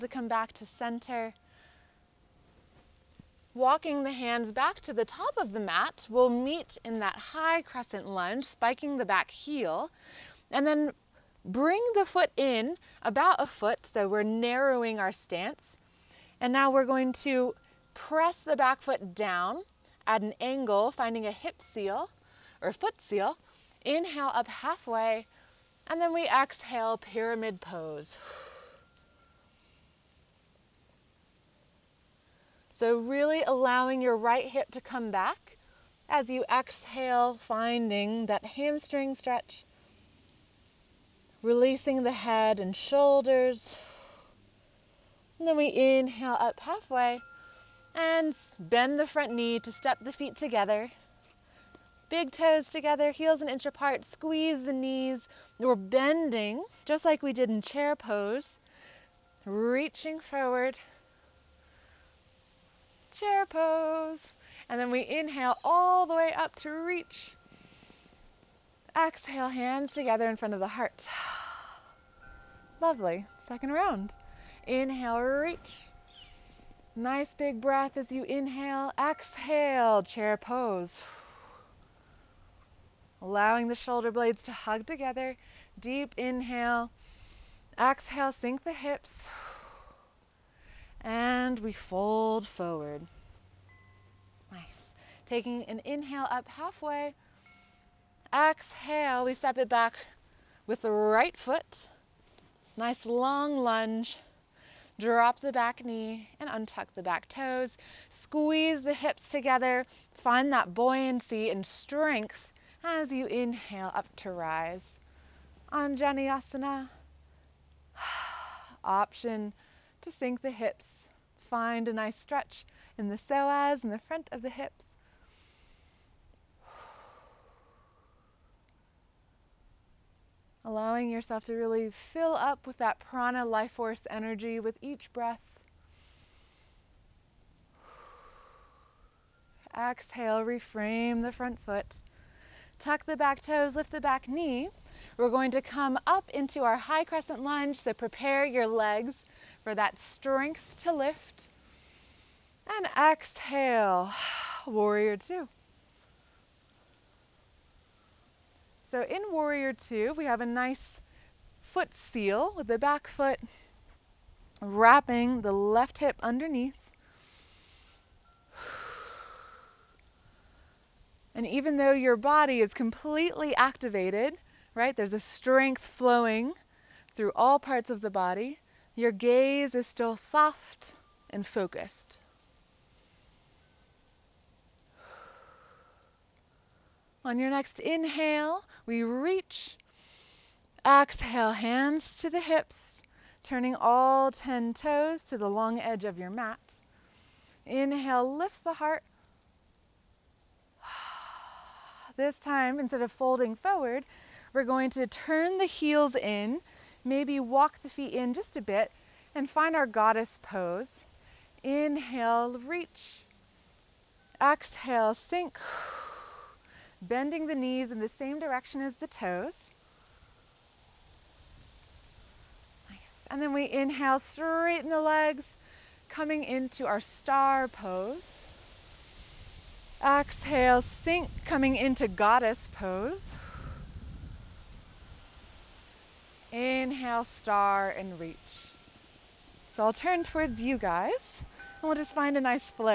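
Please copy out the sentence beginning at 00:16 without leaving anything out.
And now we're going to press the back foot down at an angle, finding a hip seal or foot seal.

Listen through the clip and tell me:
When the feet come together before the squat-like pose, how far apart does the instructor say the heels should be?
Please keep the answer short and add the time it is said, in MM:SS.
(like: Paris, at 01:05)
an inch, at 00:53.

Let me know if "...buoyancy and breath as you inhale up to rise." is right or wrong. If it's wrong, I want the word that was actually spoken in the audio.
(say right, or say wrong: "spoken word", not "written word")
wrong: "strength", not "breath".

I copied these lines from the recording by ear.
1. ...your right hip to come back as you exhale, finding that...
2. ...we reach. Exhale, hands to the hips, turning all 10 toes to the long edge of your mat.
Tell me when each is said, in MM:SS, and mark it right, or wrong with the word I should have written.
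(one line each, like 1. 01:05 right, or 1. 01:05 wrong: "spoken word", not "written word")
1. 00:34 right
2. 03:08 right.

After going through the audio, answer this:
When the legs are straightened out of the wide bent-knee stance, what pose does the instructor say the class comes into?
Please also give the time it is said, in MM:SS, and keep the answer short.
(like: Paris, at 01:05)
star pose, at 03:47.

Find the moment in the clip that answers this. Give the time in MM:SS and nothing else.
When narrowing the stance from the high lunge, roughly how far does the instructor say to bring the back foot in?
00:13.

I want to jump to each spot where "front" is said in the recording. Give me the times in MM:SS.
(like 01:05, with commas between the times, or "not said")
00:49, 01:10, 02:03, 02:21.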